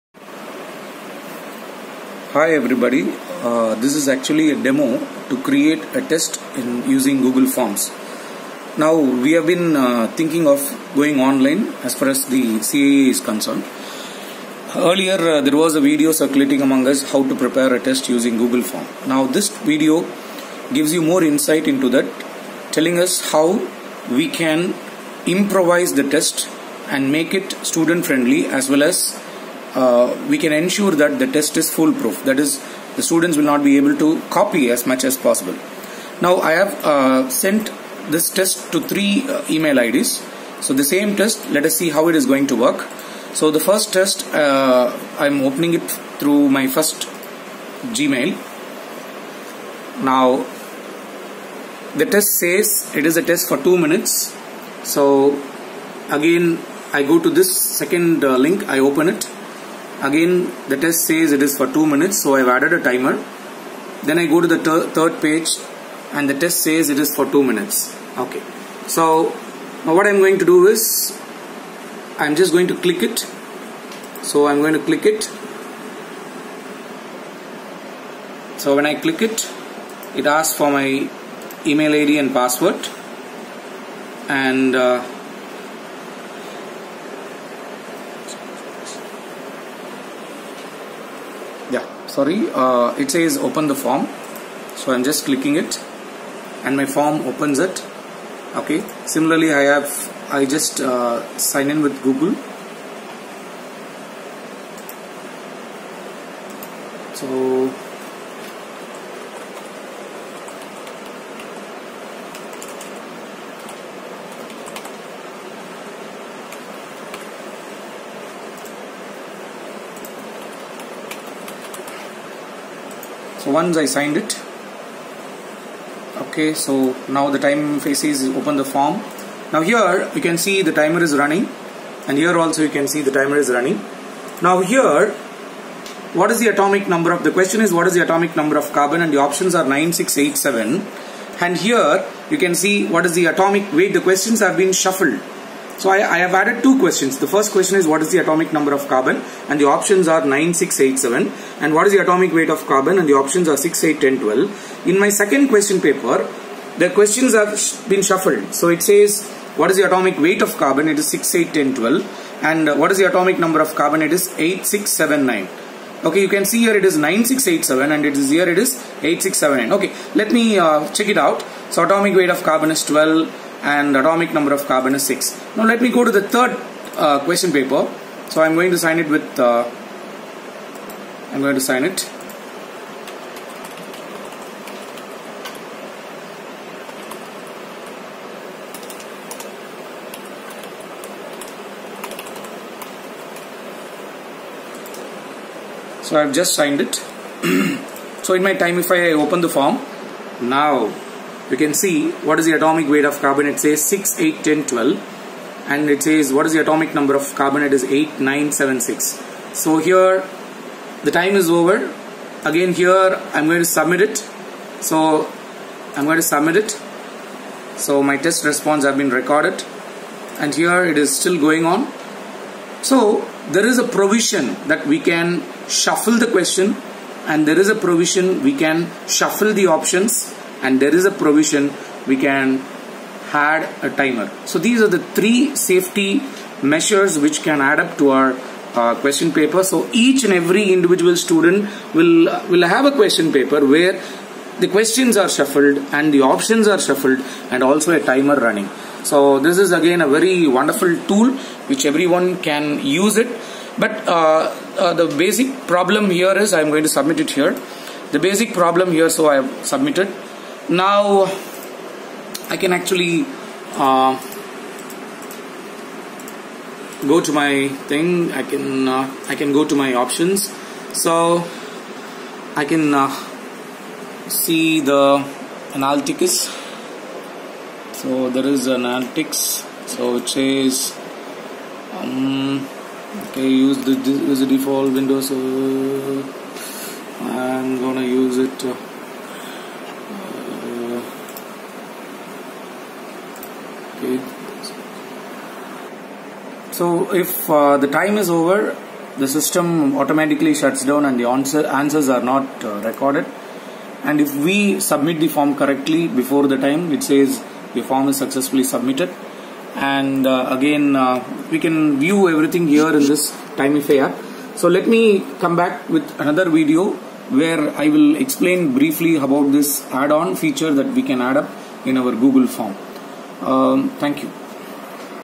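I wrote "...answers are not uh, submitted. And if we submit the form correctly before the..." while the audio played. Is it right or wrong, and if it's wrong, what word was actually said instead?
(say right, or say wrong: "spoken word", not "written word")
wrong: "recorded", not "submitted".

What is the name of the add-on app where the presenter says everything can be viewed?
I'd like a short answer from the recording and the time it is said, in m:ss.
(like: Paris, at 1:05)
Timify, at 5:13.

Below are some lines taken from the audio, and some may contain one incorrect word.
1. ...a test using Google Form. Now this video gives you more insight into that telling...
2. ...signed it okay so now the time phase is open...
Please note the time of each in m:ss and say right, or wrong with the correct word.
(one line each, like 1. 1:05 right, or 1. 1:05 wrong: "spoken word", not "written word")
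1. 0:17 right
2. 2:03 right.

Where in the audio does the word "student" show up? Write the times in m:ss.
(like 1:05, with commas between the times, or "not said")
0:27, 0:33, 4:01.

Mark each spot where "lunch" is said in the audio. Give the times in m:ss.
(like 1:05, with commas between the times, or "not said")
not said.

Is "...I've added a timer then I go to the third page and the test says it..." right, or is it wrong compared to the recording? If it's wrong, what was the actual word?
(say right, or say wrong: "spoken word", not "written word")
right.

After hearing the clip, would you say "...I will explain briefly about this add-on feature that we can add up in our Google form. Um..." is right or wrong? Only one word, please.
right.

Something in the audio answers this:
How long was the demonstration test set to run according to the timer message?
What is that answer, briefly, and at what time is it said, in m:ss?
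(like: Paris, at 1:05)
2 minutes, at 0:53.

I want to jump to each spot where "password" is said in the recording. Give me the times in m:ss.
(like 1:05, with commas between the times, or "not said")
1:22.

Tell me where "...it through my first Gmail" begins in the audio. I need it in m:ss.
0:45.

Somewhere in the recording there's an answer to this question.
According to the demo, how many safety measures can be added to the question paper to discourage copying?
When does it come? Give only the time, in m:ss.
3:55.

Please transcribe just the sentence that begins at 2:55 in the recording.
Now let me go to the third uh, question paper.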